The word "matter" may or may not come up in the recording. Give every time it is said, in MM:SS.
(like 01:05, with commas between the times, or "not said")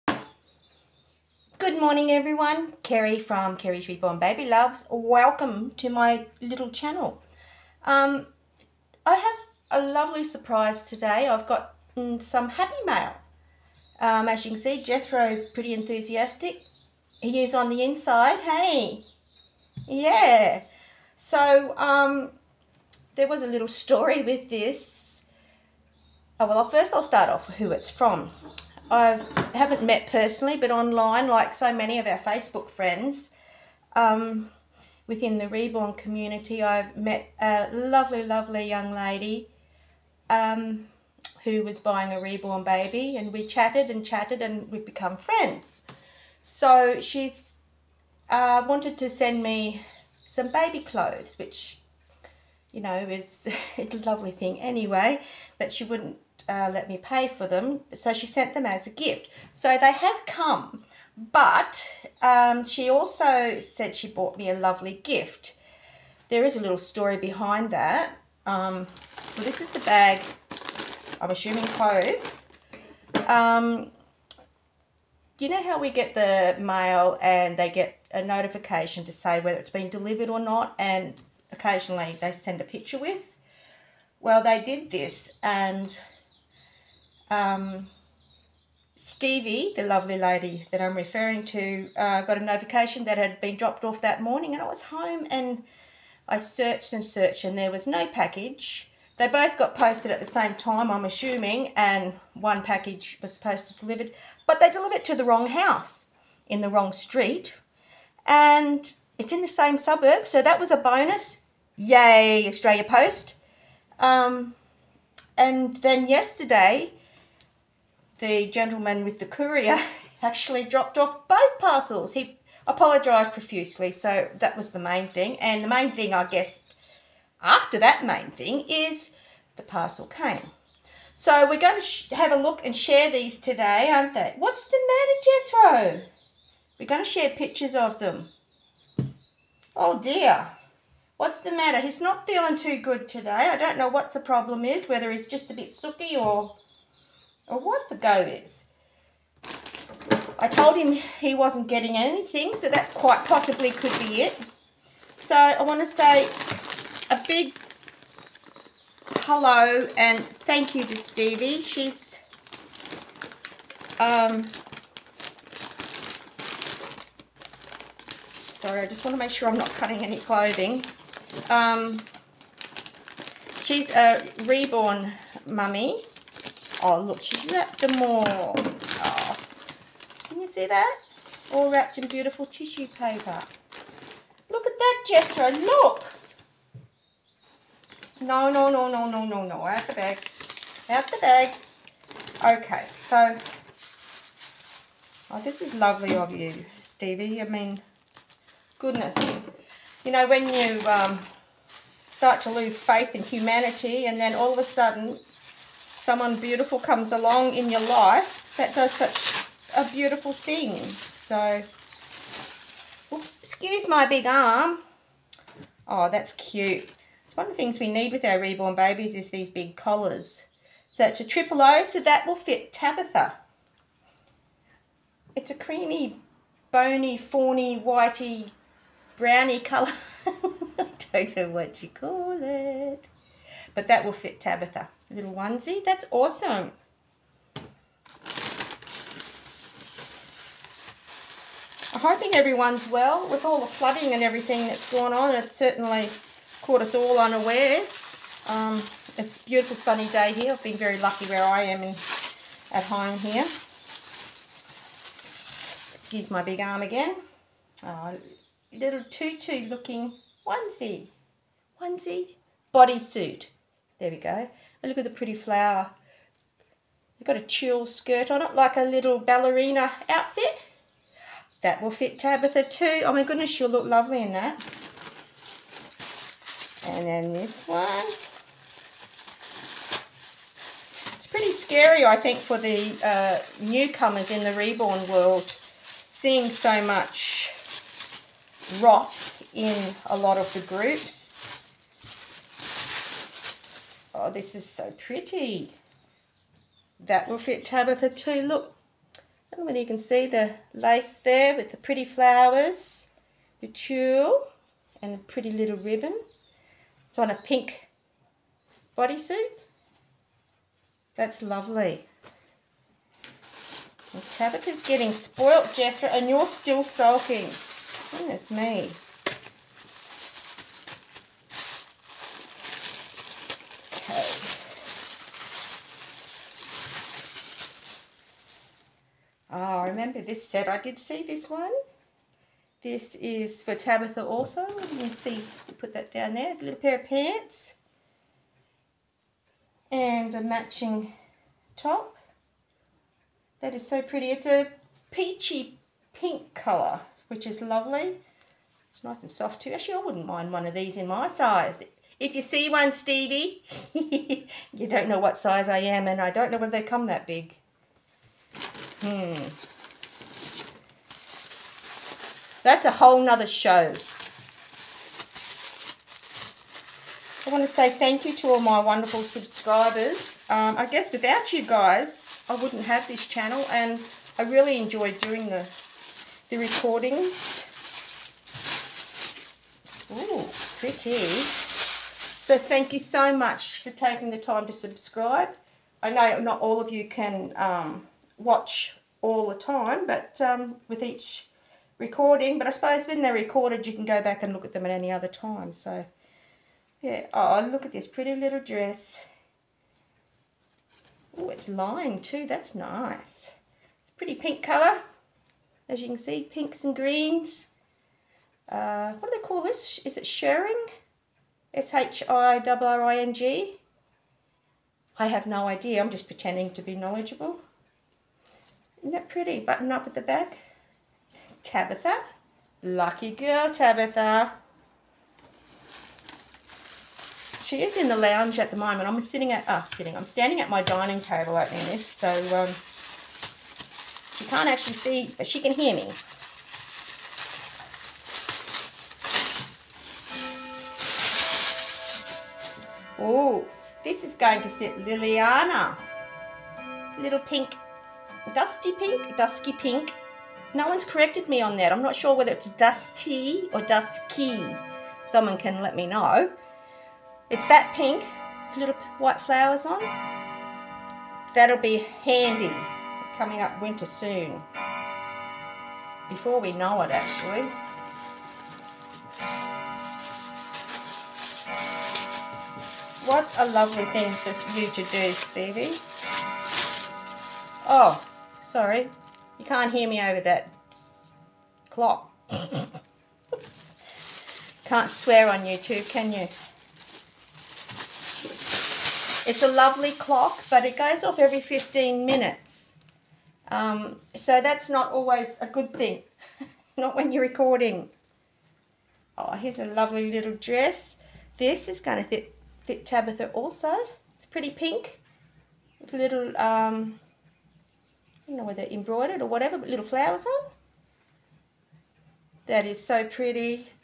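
02:14, 02:21.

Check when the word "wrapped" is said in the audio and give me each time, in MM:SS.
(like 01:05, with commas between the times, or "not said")
02:57, 03:01.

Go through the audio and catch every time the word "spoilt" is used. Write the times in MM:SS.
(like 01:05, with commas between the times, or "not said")
05:15.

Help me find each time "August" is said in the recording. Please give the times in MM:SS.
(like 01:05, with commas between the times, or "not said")
not said.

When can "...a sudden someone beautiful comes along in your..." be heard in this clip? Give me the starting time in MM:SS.
03:24.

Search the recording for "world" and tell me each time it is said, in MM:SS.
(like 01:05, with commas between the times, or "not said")
04:45.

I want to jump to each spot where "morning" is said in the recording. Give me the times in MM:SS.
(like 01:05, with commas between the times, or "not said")
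00:01, 01:34.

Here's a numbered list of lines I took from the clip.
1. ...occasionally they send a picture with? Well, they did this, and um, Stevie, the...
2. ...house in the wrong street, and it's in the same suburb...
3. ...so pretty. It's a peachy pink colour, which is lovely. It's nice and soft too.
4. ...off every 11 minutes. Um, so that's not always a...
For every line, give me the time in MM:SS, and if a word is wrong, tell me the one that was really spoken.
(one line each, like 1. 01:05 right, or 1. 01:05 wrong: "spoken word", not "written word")
1. 01:21 right
2. 01:45 right
3. 05:43 right
4. 08:11 wrong: "15", not "11".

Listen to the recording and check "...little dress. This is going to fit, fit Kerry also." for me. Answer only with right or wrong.
wrong.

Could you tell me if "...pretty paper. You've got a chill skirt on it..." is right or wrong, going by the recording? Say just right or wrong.
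wrong.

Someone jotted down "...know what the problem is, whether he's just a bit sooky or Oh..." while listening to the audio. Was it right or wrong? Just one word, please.
right.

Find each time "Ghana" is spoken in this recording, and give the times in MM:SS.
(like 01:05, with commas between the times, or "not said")
not said.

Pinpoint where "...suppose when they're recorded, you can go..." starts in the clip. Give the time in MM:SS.
06:32.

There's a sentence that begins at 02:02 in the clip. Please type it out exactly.
He apologised profusely, so that was the main thing.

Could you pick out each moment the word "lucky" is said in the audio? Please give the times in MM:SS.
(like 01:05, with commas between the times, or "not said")
04:10, 07:02.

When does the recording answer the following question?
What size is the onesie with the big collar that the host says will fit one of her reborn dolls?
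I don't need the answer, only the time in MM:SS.
03:41.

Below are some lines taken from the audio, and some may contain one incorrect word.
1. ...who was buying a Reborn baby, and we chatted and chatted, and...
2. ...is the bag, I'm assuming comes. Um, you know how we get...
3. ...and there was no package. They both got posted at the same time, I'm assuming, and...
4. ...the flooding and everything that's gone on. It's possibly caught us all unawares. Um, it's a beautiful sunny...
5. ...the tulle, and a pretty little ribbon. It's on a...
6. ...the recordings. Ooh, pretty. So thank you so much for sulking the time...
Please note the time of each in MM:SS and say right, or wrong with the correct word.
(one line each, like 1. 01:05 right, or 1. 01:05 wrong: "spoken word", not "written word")
1. 00:41 right
2. 01:09 wrong: "clothes", not "comes"
3. 01:37 right
4. 04:03 wrong: "certainly", not "possibly"
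5. 05:03 right
6. 06:16 wrong: "taking", not "sulking".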